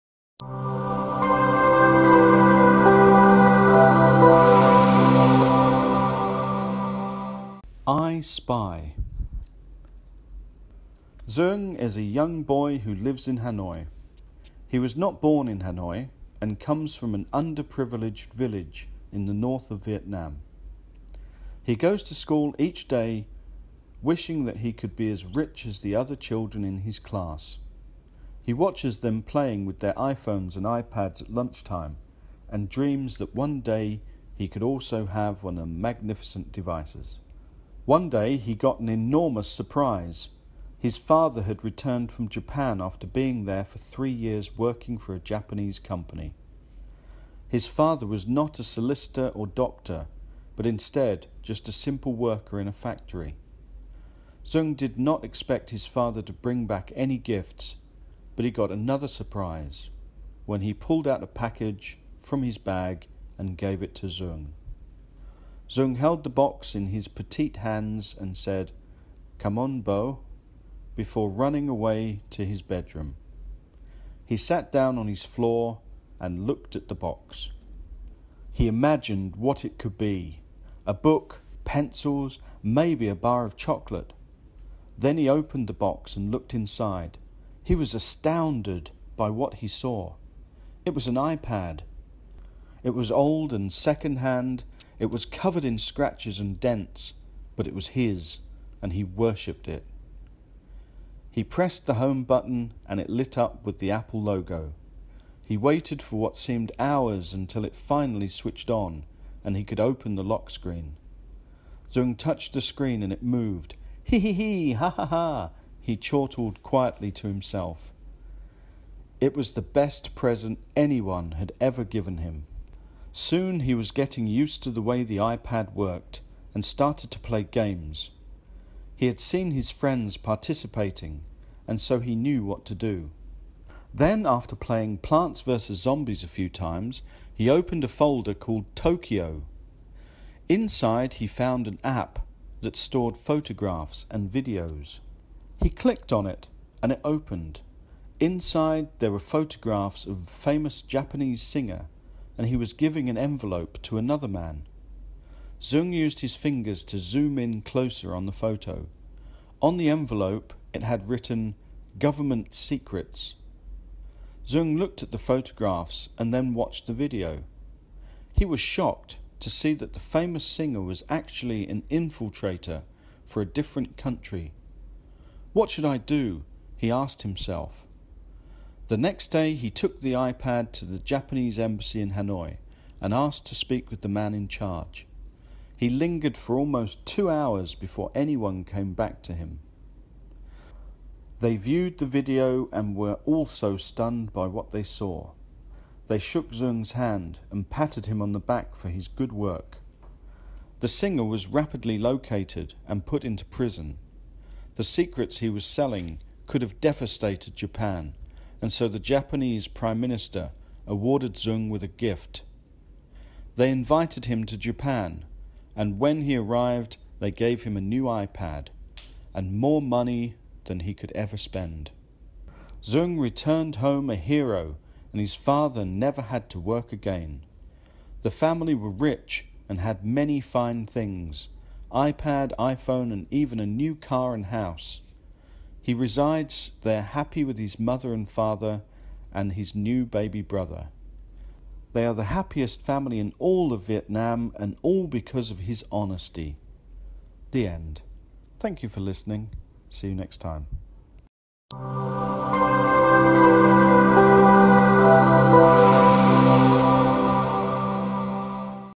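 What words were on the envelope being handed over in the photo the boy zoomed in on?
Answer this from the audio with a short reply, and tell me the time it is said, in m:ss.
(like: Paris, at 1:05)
Government Secrets, at 2:41.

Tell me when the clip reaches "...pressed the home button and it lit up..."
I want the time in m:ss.
1:41.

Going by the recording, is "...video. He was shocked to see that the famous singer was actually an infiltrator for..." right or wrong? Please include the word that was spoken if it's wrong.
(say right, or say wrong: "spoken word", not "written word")
right.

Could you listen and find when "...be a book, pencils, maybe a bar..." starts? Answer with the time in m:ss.
1:19.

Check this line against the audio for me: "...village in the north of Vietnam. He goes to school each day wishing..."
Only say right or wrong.
right.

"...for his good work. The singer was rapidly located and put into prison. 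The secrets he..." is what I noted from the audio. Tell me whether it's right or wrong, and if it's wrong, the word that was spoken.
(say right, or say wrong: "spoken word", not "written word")
right.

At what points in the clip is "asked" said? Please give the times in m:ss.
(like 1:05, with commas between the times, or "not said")
2:56, 3:03.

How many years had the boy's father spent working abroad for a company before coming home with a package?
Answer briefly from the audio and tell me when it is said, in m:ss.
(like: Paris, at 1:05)
3, at 0:43.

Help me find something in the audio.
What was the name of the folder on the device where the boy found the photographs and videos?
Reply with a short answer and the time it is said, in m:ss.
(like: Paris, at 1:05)
Tokyo, at 2:18.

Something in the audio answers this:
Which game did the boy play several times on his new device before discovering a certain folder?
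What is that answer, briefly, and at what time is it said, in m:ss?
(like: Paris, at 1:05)
Plants vs. Zombies, at 2:14.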